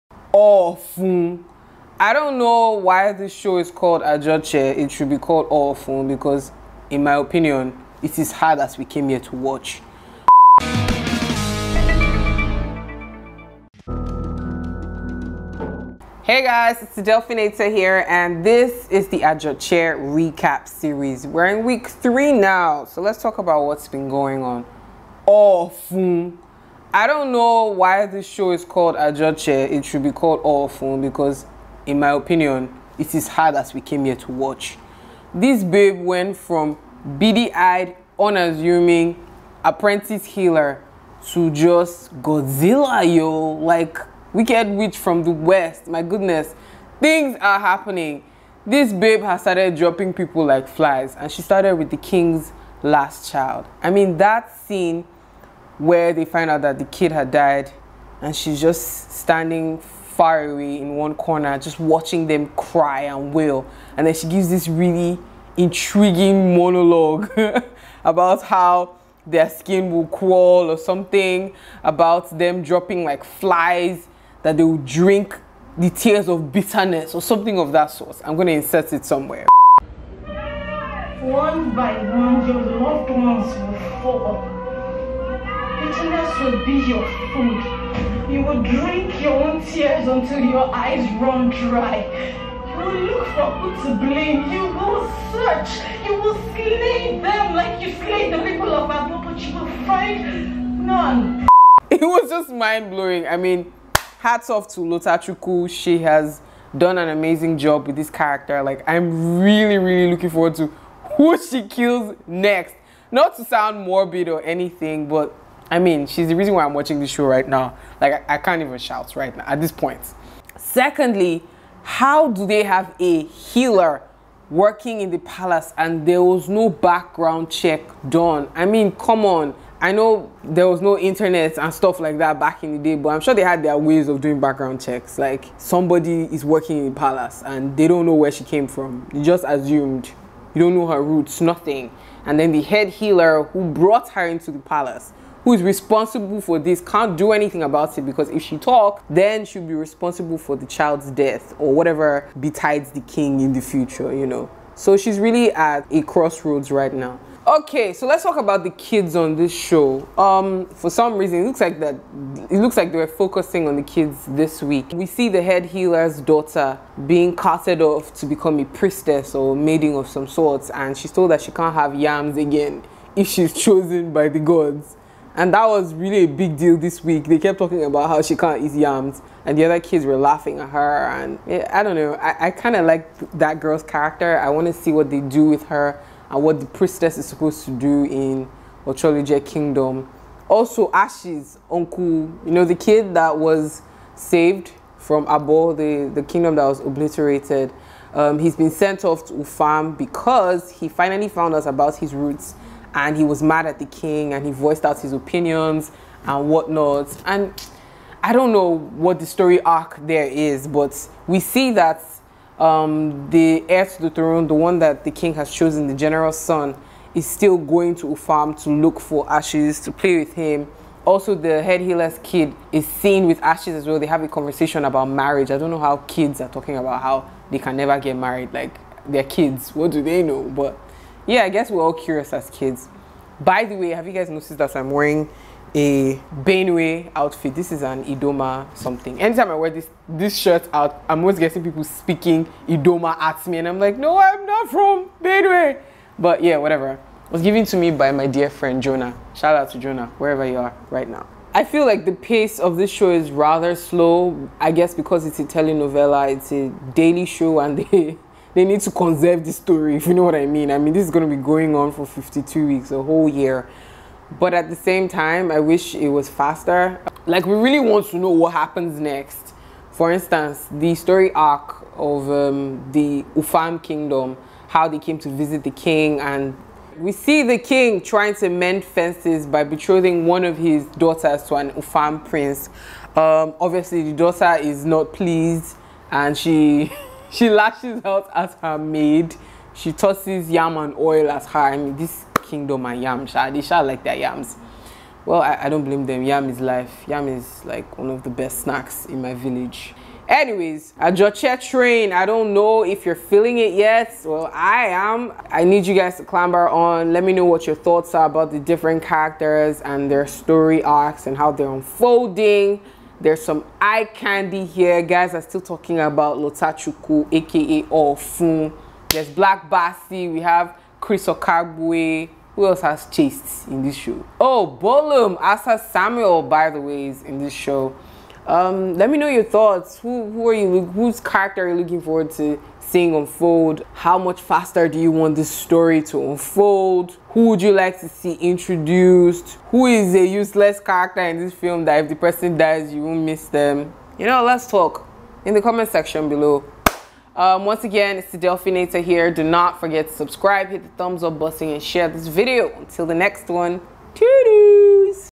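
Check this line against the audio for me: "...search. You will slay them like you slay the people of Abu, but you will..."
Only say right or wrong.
right.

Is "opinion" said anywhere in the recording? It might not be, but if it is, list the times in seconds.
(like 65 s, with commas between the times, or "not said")
7 s, 32 s, 205 s.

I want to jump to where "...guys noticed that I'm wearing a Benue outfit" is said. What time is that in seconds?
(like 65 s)
234 s.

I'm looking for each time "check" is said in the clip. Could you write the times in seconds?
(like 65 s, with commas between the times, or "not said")
127 s, 134 s.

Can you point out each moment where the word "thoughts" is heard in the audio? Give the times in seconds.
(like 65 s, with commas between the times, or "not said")
307 s, 329 s.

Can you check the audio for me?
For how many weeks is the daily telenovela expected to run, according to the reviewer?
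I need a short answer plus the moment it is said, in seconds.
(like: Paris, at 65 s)
52, at 262 s.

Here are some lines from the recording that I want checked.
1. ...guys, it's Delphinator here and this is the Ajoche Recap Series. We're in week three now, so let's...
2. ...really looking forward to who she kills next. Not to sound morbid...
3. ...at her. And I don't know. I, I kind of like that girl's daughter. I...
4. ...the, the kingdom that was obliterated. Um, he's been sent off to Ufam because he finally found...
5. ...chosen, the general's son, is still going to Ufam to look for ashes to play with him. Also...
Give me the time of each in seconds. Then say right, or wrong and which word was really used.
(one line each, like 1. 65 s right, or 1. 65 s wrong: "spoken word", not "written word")
1. 16 s right
2. 109 s right
3. 180 s wrong: "character", not "daughter"
4. 195 s right
5. 215 s right.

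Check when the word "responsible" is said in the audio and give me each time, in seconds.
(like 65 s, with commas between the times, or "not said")
145 s, 149 s.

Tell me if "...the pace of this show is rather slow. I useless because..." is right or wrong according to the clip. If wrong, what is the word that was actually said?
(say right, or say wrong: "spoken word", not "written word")
wrong: "guess", not "useless".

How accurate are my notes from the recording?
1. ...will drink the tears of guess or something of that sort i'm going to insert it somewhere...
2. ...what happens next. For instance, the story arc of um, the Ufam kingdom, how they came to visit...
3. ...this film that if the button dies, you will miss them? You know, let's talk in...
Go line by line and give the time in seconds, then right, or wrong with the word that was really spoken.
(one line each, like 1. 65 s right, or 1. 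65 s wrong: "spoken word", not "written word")
1. 74 s wrong: "bitterness", not "guess"
2. 268 s right
3. 341 s wrong: "person", not "button".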